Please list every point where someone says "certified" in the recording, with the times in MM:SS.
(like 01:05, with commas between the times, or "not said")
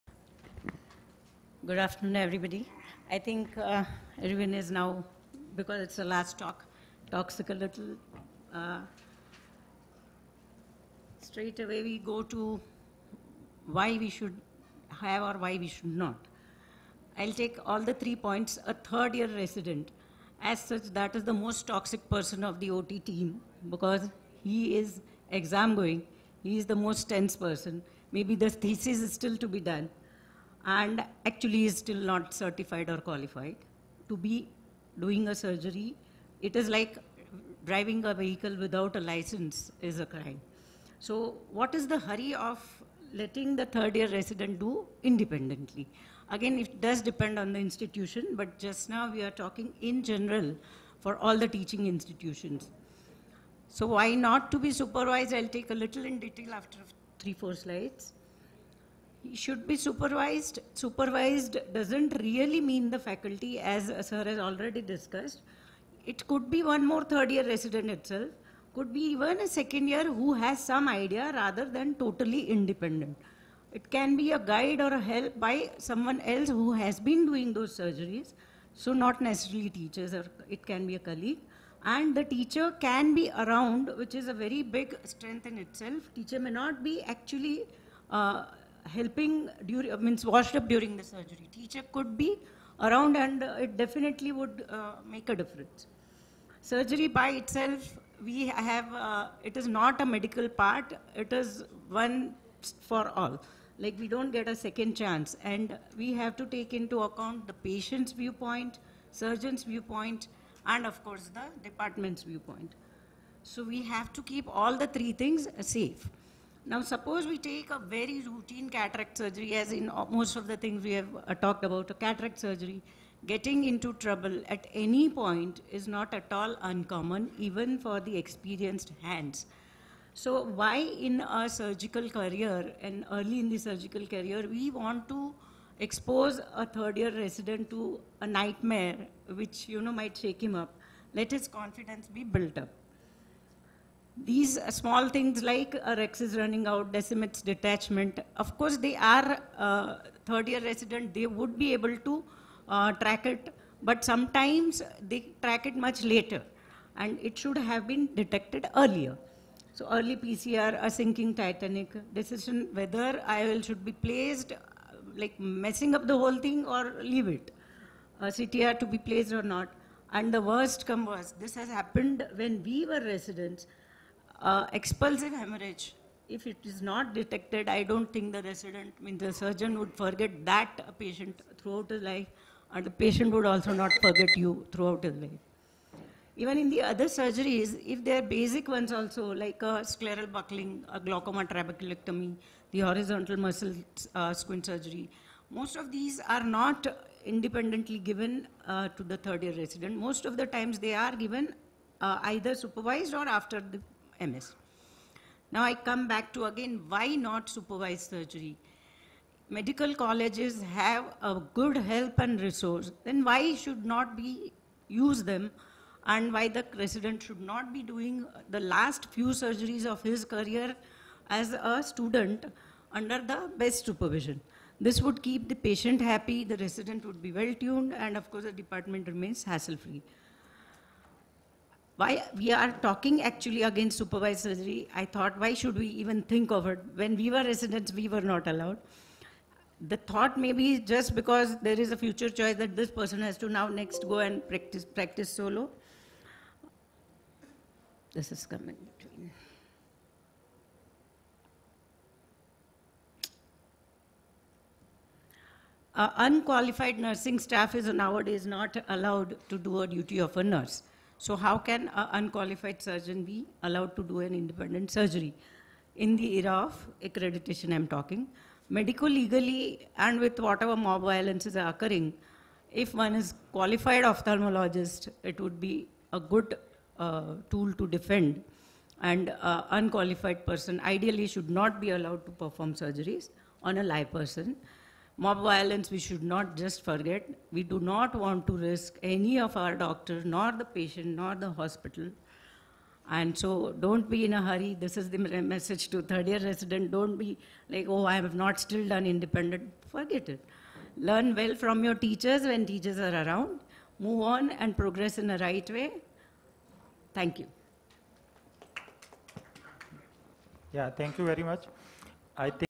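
00:32.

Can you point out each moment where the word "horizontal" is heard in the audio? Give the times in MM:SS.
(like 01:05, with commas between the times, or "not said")
03:12.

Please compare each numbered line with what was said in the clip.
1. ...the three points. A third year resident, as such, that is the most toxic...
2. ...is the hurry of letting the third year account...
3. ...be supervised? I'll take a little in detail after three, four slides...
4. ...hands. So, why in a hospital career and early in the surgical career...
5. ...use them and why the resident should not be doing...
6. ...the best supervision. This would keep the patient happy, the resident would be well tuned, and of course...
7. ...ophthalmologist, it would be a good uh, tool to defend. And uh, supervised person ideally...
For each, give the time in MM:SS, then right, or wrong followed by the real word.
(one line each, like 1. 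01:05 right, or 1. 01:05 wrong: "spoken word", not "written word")
1. 00:17 right
2. 00:41 wrong: "resident", not "account"
3. 00:54 right
4. 02:09 wrong: "surgical", not "hospital"
5. 03:34 right
6. 03:43 right
7. 04:34 wrong: "unqualified", not "supervised".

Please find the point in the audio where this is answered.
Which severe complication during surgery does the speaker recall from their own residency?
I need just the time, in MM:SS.
02:54.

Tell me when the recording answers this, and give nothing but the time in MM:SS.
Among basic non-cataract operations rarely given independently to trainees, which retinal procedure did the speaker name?
03:09.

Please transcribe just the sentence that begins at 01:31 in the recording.
Teacher could be around and uh, it definitely would uh, make a difference.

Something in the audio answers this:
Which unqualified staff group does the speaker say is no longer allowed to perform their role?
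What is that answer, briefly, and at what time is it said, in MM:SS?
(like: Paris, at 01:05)
nursing staff, at 04:17.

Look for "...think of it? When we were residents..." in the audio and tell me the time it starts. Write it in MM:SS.
03:56.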